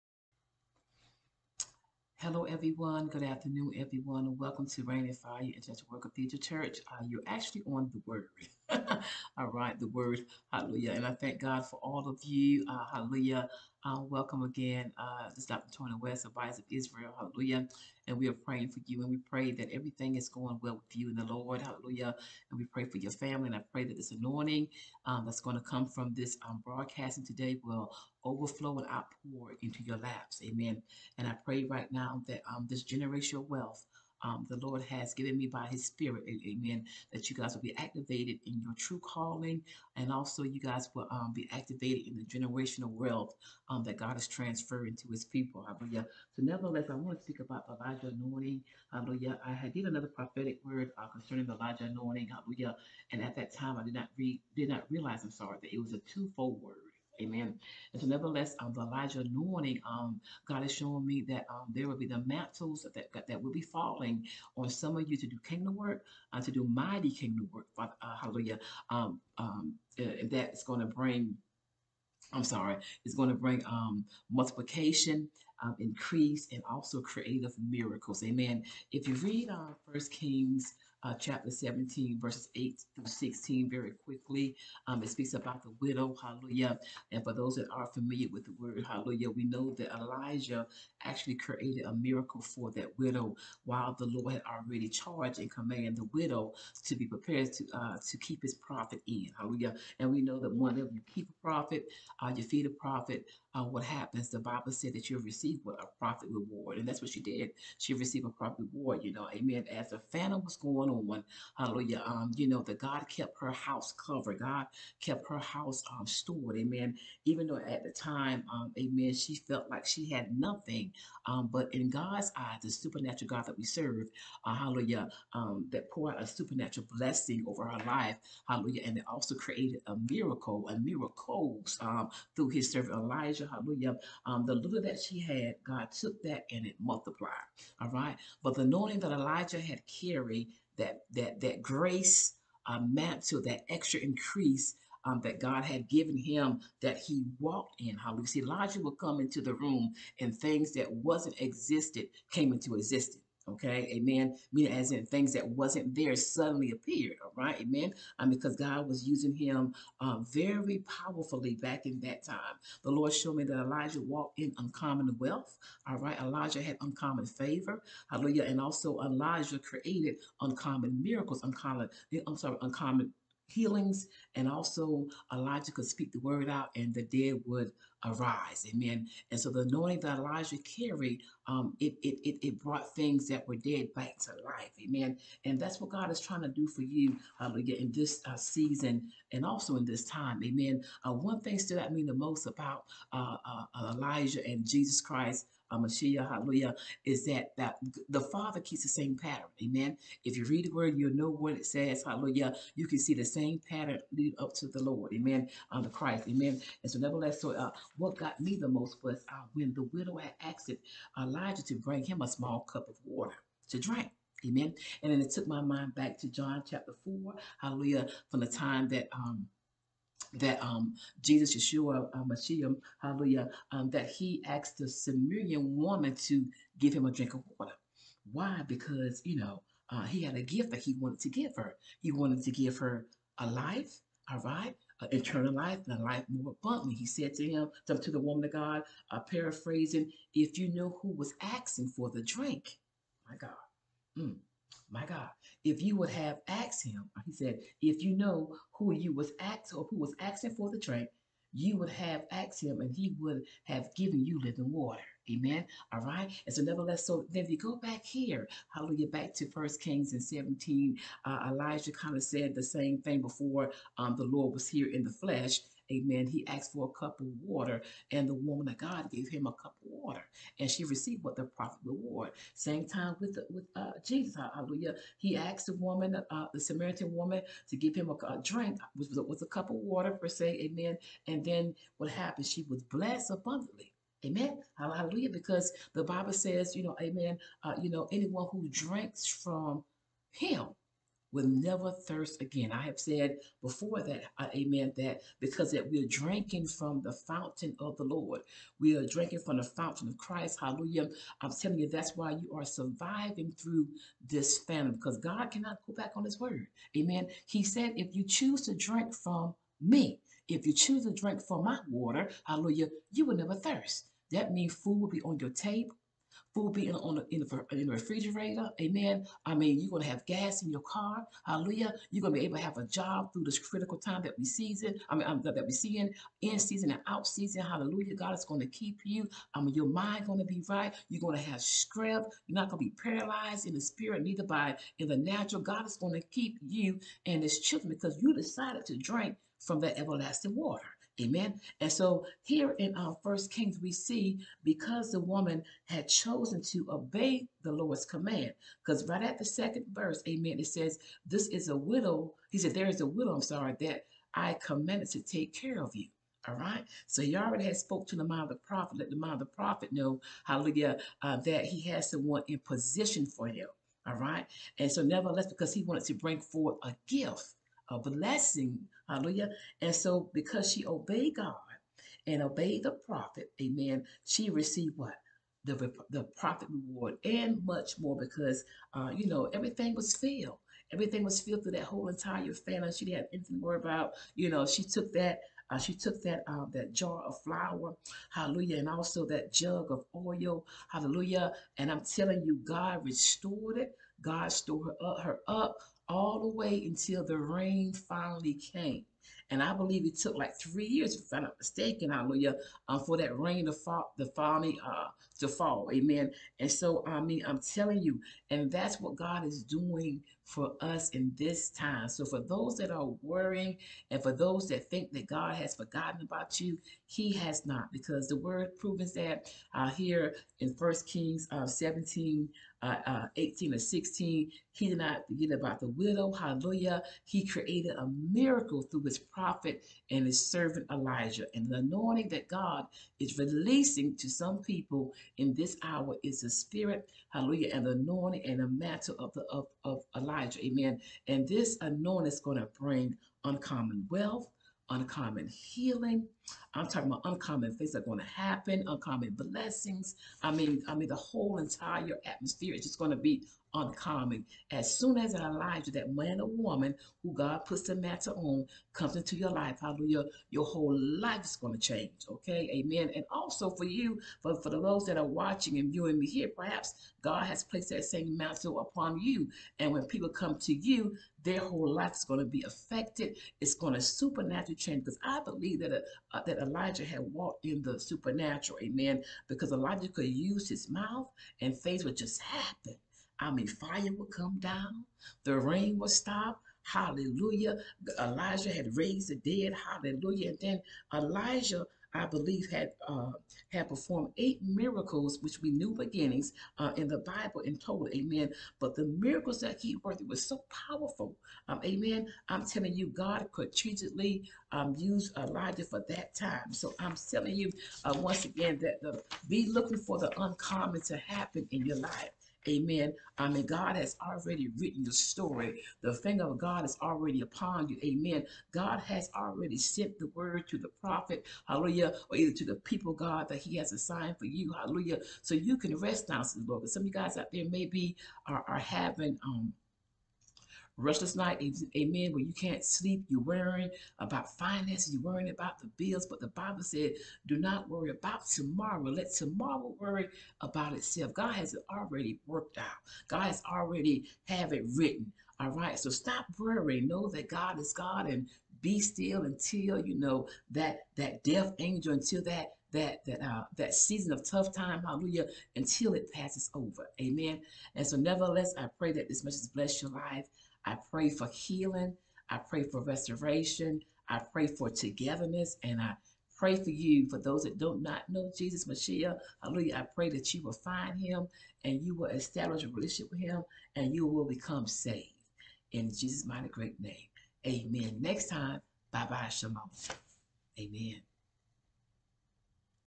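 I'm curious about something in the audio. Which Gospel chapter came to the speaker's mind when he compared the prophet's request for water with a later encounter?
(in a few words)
John chapter 4.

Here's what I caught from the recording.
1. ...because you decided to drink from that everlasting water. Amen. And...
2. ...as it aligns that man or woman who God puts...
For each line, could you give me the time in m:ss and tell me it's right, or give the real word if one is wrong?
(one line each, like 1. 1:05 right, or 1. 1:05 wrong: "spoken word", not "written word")
1. 5:37 right
2. 7:35 right.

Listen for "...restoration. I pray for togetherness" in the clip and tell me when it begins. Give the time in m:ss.
9:23.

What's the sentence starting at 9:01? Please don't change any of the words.
God has it already worked out.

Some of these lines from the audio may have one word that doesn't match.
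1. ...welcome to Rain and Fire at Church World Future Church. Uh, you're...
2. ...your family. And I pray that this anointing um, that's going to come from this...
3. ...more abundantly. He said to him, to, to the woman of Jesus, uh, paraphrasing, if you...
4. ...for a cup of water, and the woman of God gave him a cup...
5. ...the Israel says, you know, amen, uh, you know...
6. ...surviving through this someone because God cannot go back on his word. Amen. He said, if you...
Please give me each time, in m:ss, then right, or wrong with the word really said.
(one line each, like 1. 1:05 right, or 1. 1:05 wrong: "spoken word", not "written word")
1. 0:04 right
2. 0:22 right
3. 3:56 wrong: "God", not "Jesus"
4. 4:26 right
5. 4:45 wrong: "Bible", not "Israel"
6. 5:02 wrong: "famine", not "someone".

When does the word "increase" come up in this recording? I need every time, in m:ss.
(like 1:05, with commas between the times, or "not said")
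1:15, 2:23.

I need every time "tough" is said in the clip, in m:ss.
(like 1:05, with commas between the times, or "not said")
9:14.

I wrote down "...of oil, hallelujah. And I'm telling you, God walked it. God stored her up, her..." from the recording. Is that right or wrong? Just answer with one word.
wrong.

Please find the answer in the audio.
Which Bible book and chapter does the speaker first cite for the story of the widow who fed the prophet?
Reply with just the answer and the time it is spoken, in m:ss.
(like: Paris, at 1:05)
First Kings 17, at 1:19.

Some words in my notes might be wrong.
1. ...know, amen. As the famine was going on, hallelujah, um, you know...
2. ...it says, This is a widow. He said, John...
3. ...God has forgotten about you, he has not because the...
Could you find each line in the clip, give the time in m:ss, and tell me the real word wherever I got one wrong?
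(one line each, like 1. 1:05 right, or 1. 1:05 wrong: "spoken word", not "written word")
1. 1:49 right
2. 5:50 wrong: "There", not "John"
3. 6:55 right.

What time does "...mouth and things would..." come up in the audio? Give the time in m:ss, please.
8:00.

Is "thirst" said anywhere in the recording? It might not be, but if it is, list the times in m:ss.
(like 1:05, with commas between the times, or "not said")
4:51, 5:13.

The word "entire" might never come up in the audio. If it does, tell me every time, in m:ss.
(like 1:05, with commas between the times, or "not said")
6:22, 7:31.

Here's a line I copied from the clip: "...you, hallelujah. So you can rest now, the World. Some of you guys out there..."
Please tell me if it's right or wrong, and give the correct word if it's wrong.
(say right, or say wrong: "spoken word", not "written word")
wrong: "Lord", not "World".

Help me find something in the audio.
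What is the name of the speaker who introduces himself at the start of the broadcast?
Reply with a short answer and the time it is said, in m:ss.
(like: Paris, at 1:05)
Dr. Tony West, at 0:15.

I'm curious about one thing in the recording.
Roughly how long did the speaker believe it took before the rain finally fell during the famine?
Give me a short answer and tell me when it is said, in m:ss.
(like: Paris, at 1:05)
3 years, at 6:40.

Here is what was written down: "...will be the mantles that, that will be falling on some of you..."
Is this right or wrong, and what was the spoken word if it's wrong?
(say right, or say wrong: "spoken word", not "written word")
right.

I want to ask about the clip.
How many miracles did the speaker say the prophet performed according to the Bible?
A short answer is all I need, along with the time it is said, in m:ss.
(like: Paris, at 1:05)
8, at 8:14.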